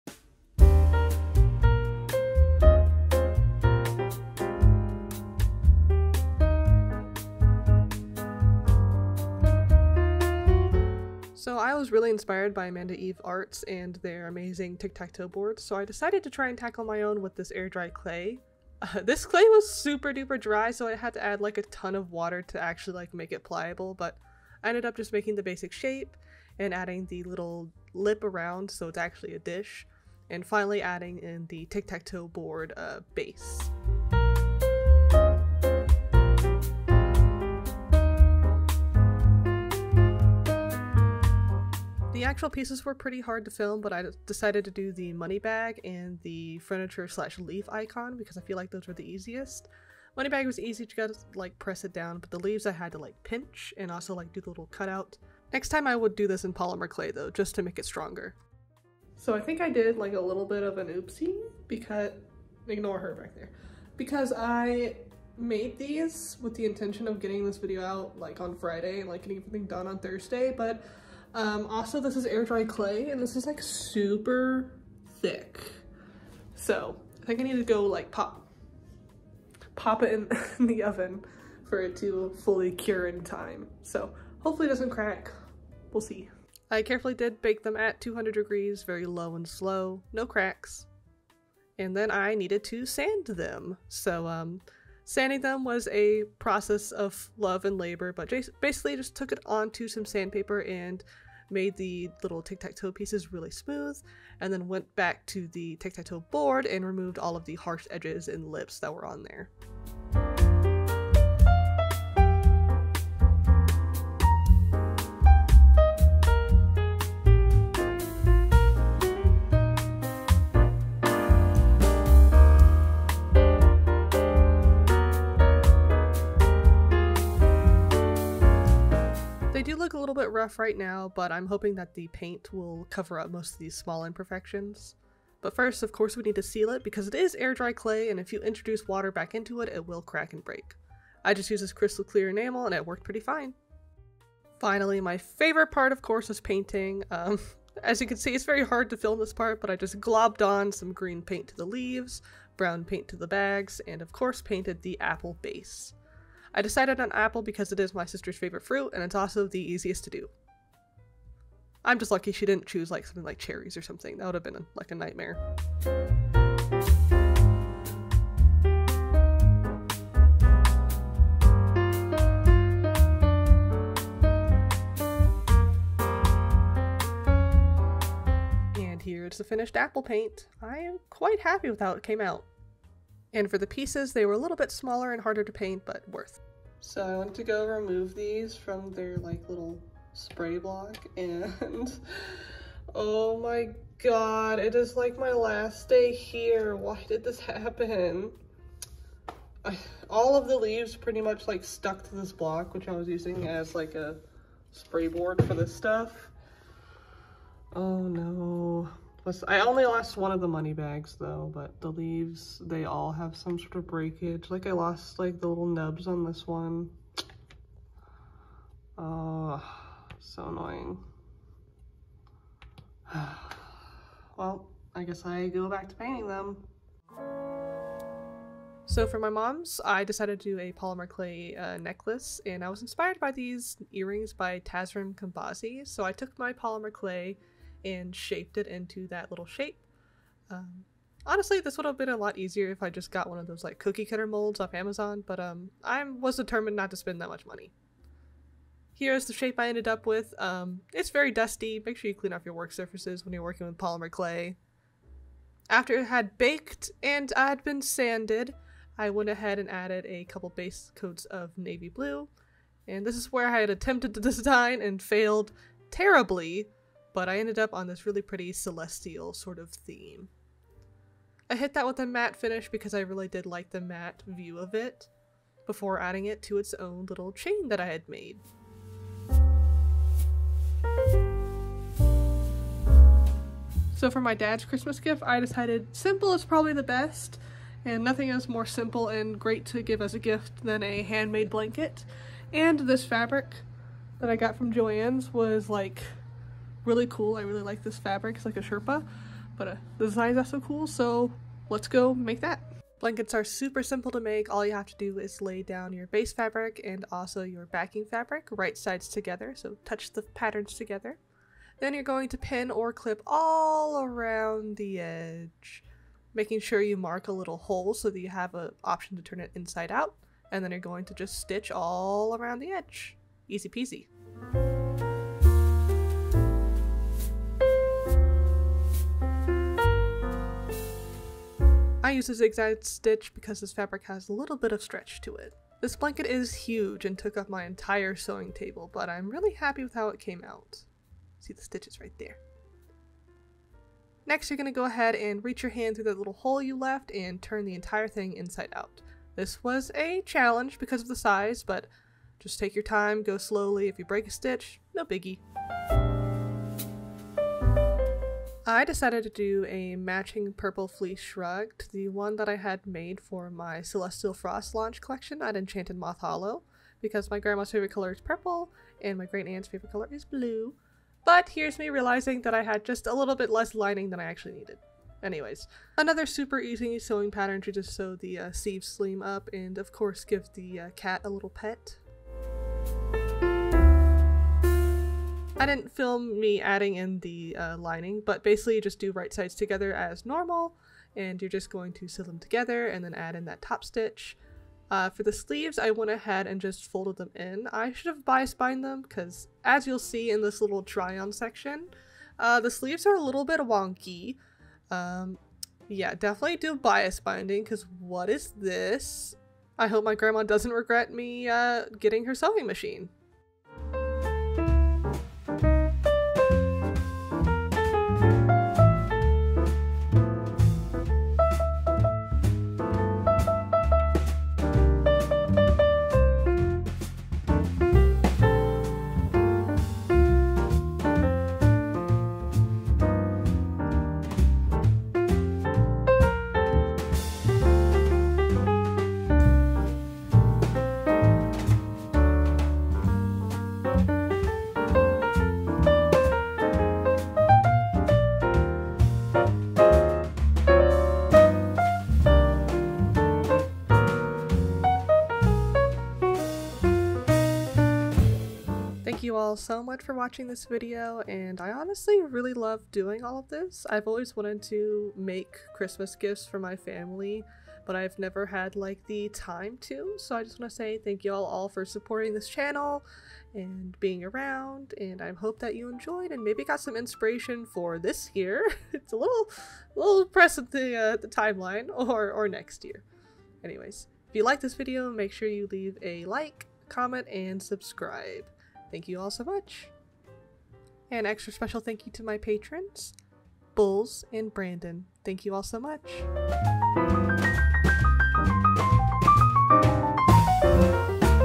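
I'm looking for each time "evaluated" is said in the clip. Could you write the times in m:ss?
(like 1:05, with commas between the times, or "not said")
not said.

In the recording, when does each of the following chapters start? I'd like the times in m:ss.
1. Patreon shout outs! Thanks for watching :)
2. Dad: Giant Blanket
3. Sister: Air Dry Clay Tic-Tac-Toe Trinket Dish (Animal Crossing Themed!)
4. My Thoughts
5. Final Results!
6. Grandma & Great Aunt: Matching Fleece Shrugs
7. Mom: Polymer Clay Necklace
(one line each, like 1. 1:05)
1. 8:10
2. 4:42
3. 0:10
4. 7:39
5. 6:54
6. 5:56
7. 3:47.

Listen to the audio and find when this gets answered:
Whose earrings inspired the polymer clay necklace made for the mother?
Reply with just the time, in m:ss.
3:54.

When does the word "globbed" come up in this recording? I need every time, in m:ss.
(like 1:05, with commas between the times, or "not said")
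2:30.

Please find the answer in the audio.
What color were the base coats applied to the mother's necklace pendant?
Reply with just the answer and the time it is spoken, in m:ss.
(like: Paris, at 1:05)
navy blue, at 4:21.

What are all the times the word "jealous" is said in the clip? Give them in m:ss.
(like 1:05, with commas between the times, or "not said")
not said.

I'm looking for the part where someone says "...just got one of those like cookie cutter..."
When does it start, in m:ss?
4:02.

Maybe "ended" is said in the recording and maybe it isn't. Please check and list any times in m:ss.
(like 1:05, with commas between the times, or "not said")
0:24, 4:09, 4:27.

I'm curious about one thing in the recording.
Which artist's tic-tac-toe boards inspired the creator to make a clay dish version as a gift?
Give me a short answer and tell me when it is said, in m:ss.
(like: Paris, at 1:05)
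Amanda Eve Arts, at 0:12.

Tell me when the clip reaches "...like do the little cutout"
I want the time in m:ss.
0:54.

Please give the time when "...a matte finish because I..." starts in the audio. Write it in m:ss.
4:31.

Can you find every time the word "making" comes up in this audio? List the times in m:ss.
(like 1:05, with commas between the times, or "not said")
0:25, 5:16.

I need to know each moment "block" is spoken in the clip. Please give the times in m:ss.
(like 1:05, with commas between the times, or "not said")
3:10, 3:22.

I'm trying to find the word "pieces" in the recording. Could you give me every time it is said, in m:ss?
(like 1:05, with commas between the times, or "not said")
0:42, 1:42, 3:03.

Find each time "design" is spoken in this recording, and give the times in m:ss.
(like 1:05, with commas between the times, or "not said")
4:24, 5:00.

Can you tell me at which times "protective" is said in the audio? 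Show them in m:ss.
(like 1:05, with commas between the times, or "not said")
not said.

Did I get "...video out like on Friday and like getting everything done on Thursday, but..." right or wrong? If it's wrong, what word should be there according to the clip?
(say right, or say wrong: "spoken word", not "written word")
right.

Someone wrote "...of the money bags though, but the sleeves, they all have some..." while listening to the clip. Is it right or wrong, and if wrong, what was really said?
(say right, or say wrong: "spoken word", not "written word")
wrong: "leaves", not "sleeves".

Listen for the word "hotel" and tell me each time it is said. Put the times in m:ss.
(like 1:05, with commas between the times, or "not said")
not said.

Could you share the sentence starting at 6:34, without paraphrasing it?
Uh, for the sleeves, I went ahead and just folded them in.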